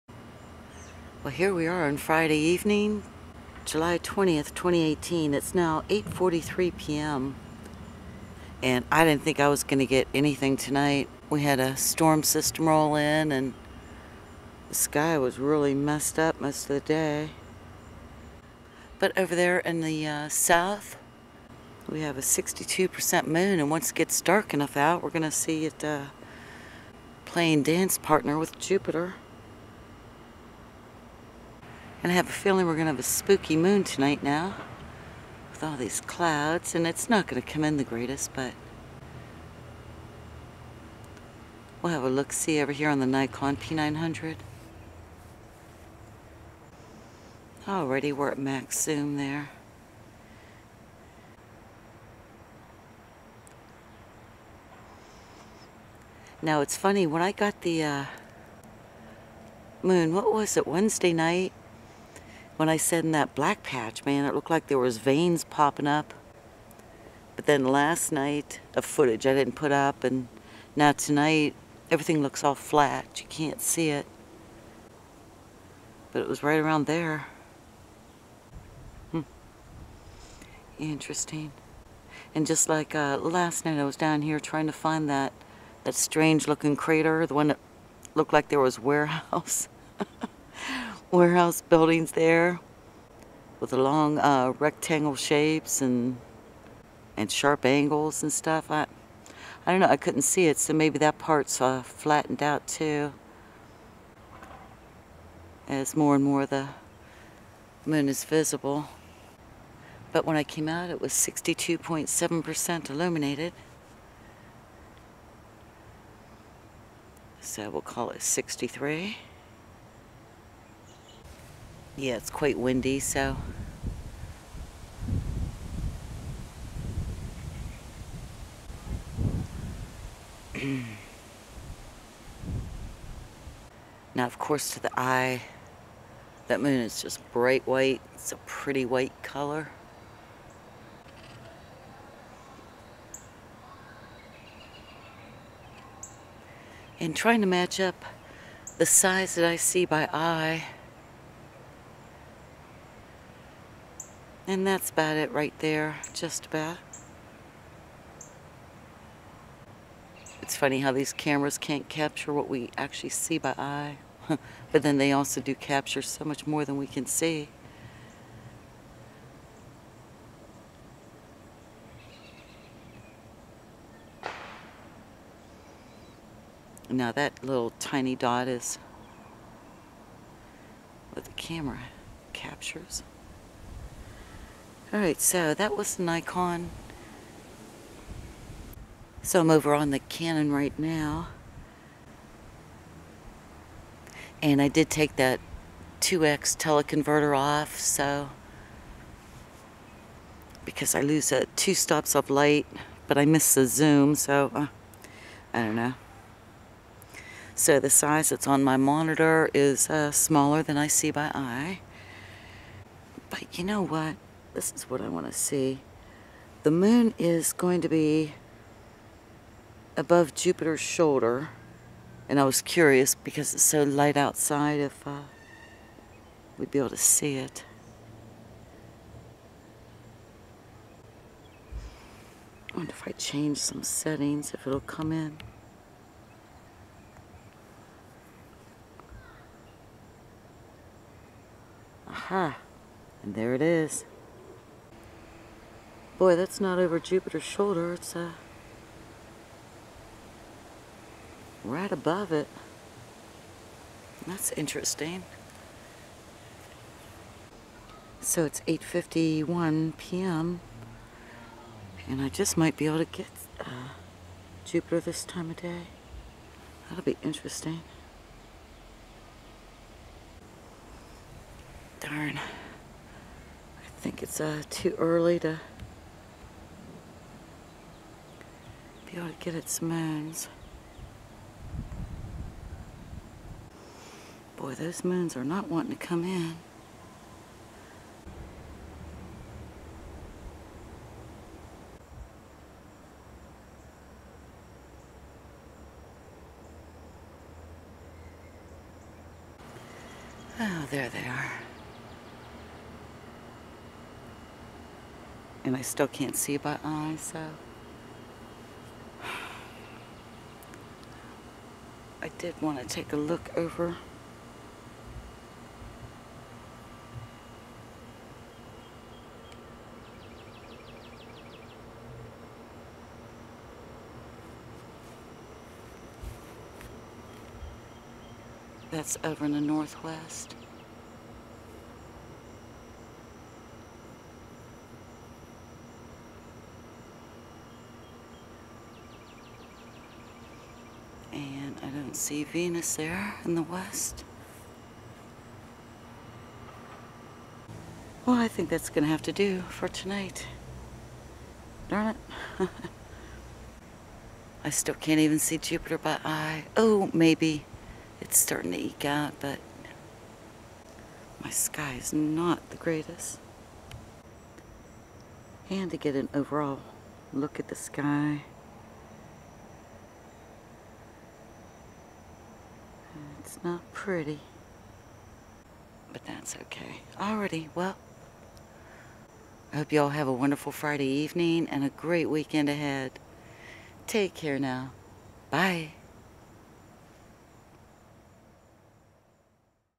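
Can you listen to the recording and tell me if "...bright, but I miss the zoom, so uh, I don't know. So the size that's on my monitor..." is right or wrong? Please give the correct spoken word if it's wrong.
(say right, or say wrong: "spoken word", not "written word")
wrong: "light", not "bright".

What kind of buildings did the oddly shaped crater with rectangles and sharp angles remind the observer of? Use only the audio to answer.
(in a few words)
warehouse buildings.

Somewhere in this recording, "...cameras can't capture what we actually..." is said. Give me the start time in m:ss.
2:41.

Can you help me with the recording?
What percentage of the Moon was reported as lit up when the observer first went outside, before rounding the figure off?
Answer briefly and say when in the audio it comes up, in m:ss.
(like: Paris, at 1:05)
62.7%, at 1:51.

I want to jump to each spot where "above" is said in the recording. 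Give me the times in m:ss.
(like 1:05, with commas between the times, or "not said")
3:39, 4:11.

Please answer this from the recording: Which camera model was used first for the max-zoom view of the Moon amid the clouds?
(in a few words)
Nikon P900.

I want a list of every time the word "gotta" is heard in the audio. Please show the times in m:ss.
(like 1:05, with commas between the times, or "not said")
4:39.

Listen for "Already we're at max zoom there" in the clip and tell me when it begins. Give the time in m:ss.
0:47.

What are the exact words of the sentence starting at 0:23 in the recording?
And once it gets dark enough out, we're going to see it uh, playing dance partner with Jupiter.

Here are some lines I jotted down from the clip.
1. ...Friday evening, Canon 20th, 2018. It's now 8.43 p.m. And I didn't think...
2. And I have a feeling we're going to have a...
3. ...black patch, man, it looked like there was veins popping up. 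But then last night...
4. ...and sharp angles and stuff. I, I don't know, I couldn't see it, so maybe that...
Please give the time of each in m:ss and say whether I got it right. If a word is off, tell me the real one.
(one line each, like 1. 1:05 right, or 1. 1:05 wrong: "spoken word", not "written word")
1. 0:01 wrong: "July", not "Canon"
2. 0:32 right
3. 1:03 right
4. 1:37 right.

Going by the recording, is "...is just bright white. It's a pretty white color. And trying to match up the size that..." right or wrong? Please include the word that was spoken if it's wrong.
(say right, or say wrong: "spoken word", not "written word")
right.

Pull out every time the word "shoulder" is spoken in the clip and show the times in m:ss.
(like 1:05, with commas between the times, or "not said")
3:40, 4:07.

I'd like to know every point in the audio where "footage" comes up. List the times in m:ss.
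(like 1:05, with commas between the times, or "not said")
1:08.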